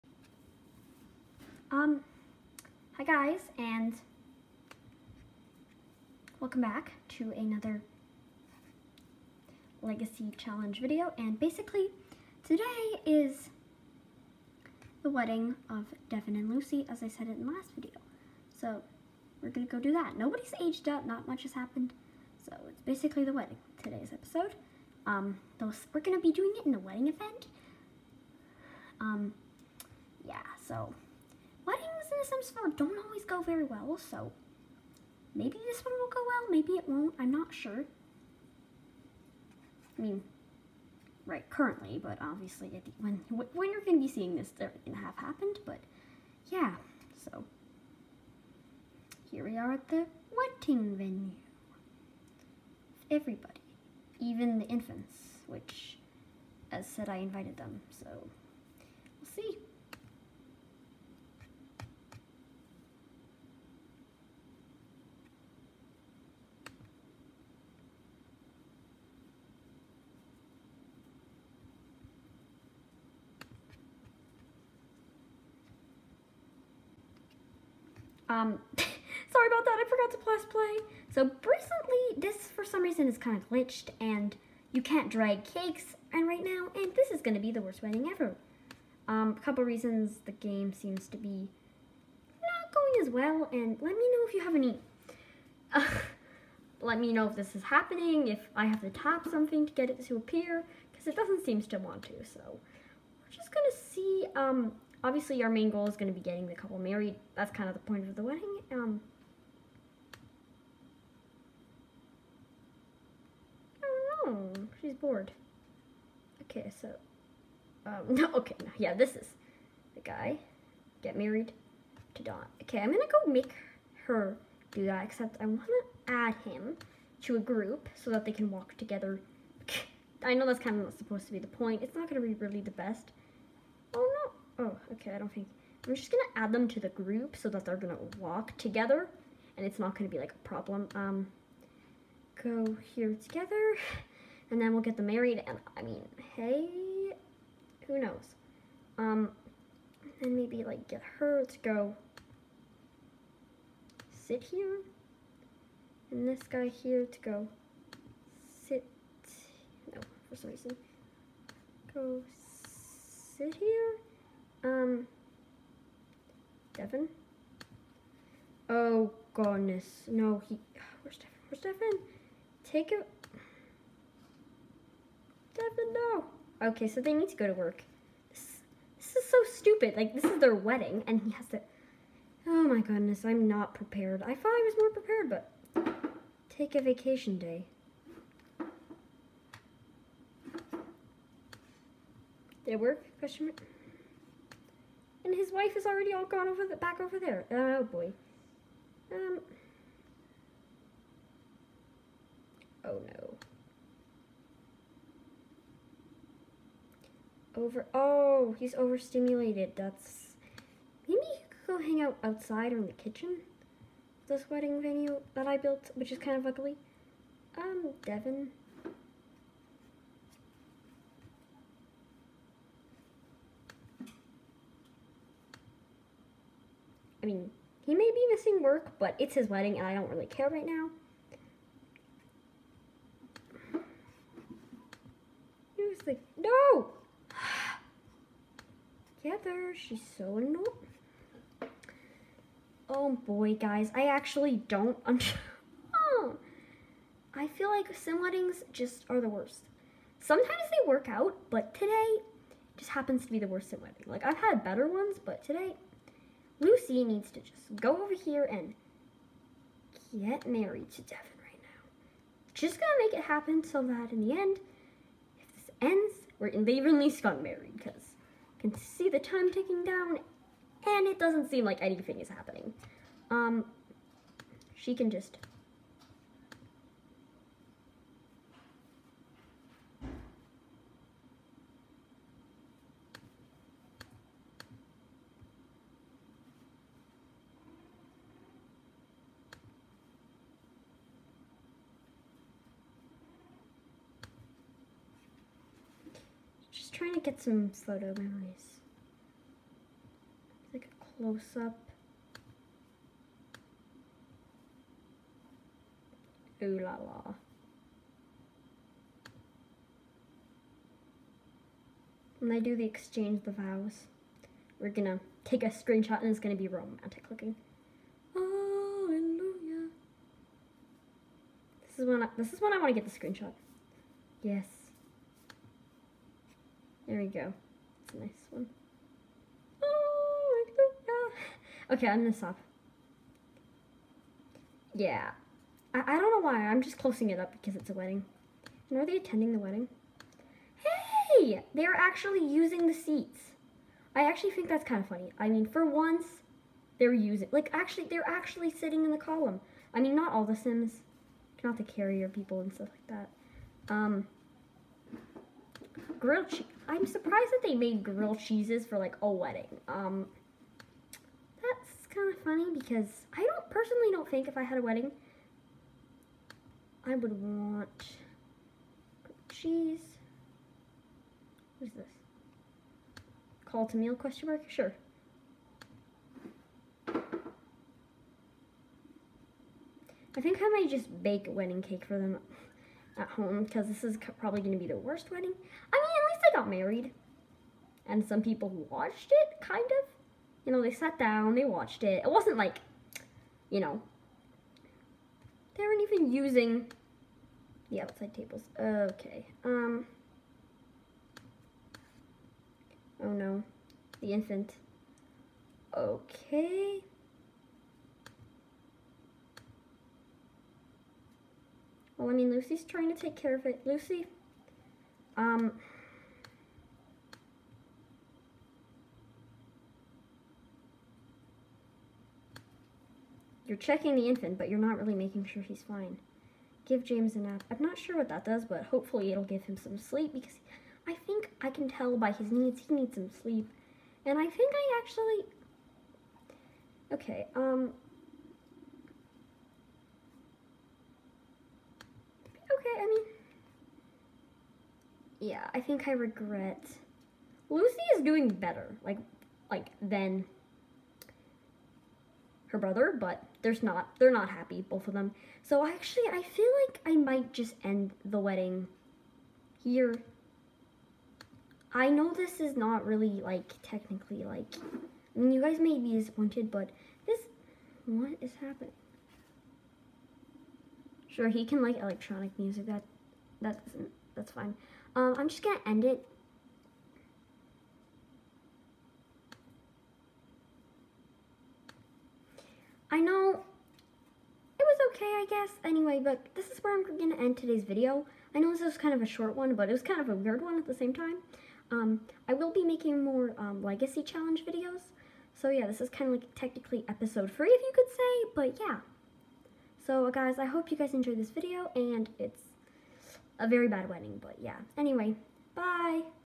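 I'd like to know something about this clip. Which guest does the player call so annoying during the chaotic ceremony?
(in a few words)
Heather.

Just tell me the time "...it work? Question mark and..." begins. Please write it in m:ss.
3:12.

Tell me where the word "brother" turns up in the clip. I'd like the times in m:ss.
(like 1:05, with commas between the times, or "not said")
7:32.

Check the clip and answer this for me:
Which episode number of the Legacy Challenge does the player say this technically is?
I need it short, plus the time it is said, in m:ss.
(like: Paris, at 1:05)
3, at 8:17.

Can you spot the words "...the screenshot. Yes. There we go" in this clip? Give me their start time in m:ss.
5:23.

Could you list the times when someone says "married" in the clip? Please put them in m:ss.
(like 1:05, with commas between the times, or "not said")
1:46, 2:01, 2:25, 4:20, 4:27, 6:26.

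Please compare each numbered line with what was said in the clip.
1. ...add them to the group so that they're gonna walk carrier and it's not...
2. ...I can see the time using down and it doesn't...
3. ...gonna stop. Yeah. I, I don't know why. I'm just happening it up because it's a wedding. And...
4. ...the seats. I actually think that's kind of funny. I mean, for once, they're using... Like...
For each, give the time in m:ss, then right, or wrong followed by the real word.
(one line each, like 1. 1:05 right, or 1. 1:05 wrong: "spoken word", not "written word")
1. 2:16 wrong: "together", not "carrier"
2. 4:28 wrong: "ticking", not "using"
3. 5:32 wrong: "closing", not "happening"
4. 5:42 right.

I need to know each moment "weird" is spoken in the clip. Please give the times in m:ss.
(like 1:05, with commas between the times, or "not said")
8:10.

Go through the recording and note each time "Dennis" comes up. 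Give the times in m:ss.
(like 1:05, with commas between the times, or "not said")
not said.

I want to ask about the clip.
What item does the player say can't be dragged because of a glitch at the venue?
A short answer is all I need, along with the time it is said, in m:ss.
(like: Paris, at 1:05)
Cakes, at 1:25.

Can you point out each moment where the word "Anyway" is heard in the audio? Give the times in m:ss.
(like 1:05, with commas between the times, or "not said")
8:05, 8:24.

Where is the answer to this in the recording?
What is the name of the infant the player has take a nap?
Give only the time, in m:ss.
7:07.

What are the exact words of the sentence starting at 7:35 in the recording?
So actually, I feel like I might just end the wedding here.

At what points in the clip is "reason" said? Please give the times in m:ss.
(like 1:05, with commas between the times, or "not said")
1:22, 1:29, 2:40.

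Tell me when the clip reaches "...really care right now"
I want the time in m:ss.
3:50.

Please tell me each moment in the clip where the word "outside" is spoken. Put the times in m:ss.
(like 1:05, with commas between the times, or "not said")
3:32, 6:38.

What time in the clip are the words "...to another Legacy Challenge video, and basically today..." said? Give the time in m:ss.
0:07.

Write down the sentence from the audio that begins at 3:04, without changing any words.
I thought I was more prepared, but take a vacation day.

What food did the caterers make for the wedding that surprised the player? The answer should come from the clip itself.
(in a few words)
Grilled cheese.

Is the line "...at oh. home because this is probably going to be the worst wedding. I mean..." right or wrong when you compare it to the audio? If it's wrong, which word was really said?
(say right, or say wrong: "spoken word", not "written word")
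right.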